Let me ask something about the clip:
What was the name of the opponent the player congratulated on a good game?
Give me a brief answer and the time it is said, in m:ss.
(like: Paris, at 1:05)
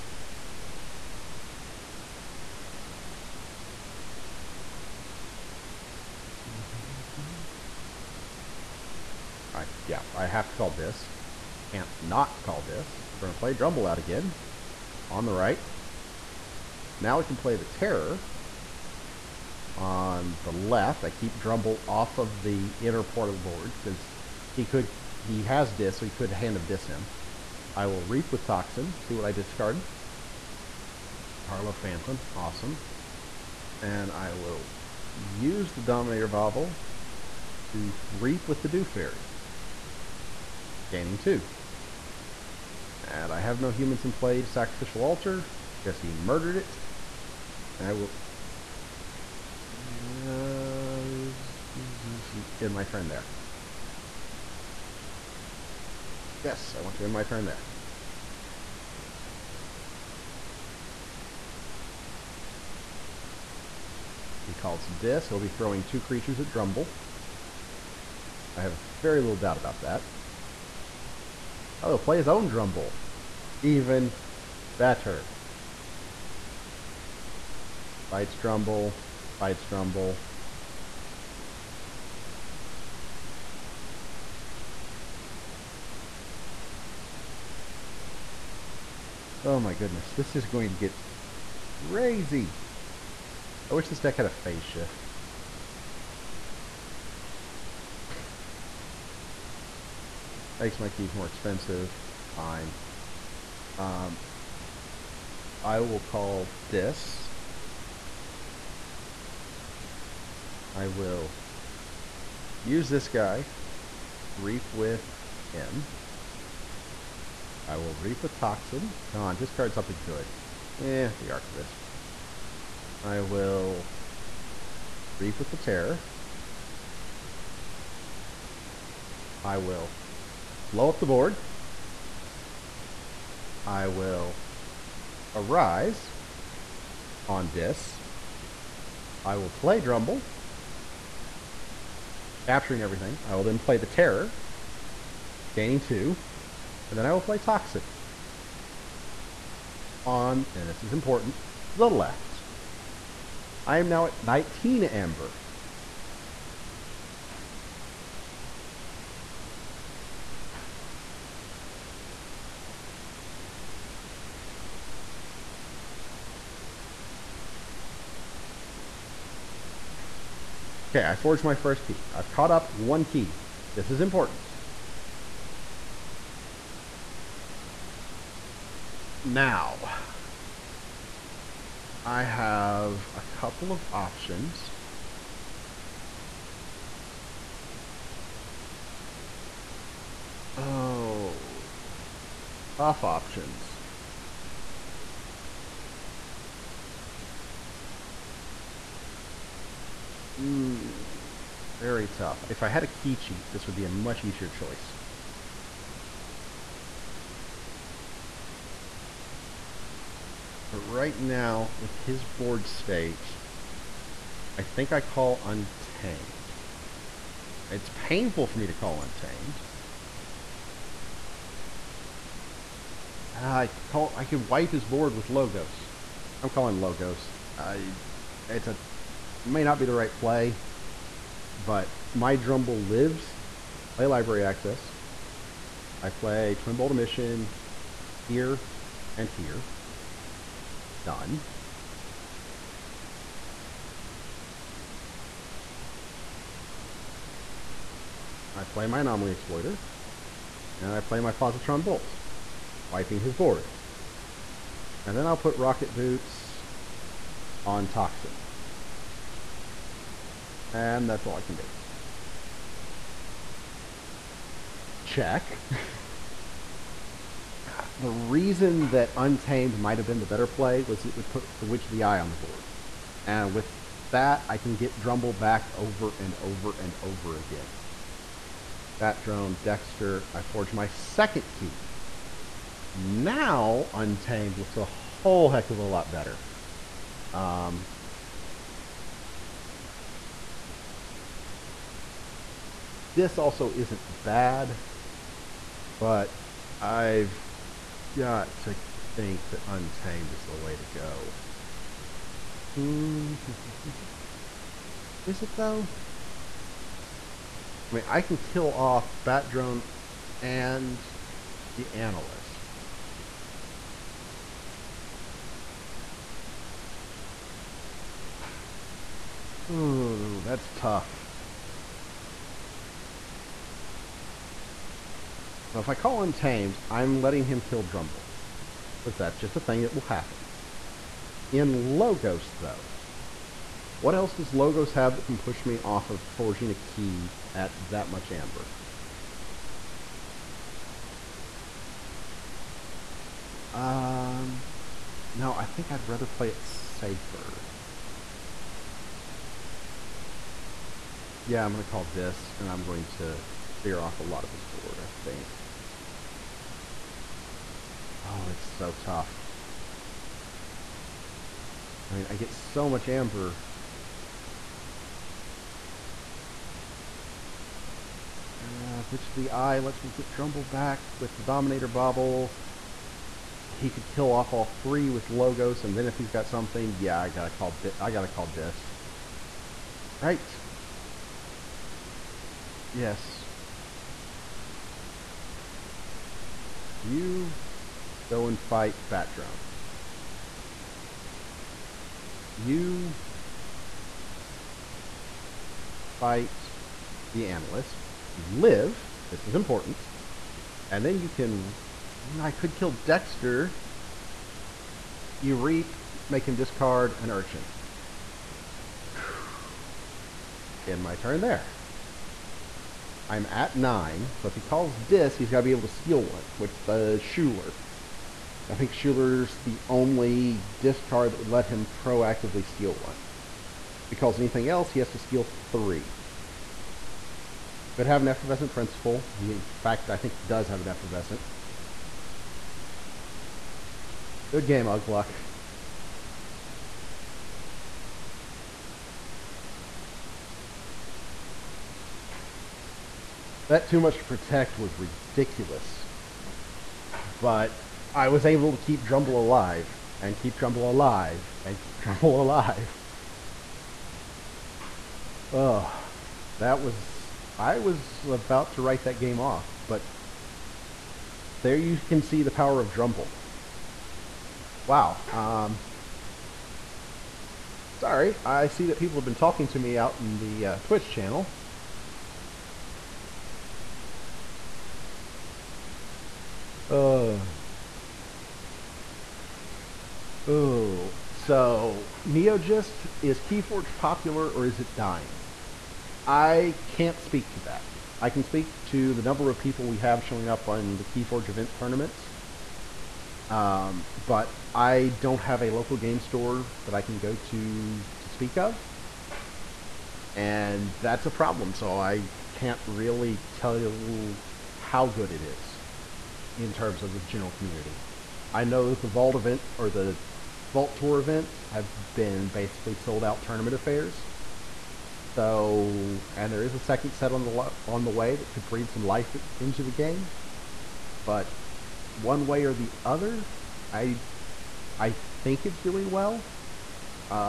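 Ugluk, at 7:14.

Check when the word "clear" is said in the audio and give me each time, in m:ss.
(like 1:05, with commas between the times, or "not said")
5:53.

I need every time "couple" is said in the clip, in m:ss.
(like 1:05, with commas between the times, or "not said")
3:03.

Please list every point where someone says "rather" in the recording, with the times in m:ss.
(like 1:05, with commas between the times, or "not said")
5:46.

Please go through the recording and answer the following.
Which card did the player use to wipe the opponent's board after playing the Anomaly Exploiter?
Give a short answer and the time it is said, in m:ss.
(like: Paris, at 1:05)
Positron Bolt, at 4:11.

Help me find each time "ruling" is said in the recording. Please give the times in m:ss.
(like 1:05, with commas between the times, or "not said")
not said.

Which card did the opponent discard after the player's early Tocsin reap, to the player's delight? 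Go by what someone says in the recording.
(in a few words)
Carlo Phantom.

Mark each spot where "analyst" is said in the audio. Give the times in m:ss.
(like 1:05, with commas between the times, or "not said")
5:11, 6:37.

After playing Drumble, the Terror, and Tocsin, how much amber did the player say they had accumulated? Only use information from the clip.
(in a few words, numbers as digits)
19.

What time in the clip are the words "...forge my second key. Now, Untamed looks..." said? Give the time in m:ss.
4:40.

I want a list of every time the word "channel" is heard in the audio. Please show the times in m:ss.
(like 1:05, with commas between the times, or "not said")
7:51.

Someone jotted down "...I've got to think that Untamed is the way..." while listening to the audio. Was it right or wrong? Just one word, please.
right.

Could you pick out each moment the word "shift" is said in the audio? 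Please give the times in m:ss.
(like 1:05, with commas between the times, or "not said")
1:34.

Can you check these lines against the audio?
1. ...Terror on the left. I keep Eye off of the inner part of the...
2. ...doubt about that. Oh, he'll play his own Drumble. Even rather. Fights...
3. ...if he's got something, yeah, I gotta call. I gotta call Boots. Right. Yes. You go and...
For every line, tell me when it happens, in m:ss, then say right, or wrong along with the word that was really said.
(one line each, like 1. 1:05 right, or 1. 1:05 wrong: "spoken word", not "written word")
1. 0:17 wrong: "Drumble", not "Eye"
2. 1:09 wrong: "better", not "rather"
3. 6:16 wrong: "Dis", not "Boots".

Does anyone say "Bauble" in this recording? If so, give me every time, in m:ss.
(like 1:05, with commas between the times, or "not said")
0:36, 6:11.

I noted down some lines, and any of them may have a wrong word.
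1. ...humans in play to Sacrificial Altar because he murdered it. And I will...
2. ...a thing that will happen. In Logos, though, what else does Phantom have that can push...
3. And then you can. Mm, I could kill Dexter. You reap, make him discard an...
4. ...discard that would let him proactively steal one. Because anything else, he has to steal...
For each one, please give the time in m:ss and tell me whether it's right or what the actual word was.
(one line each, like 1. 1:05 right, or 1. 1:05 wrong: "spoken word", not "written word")
1. 0:43 right
2. 5:29 wrong: "Logos", not "Phantom"
3. 6:40 right
4. 7:00 right.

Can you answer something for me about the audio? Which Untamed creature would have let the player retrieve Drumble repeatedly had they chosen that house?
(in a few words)
Witch of the Eye.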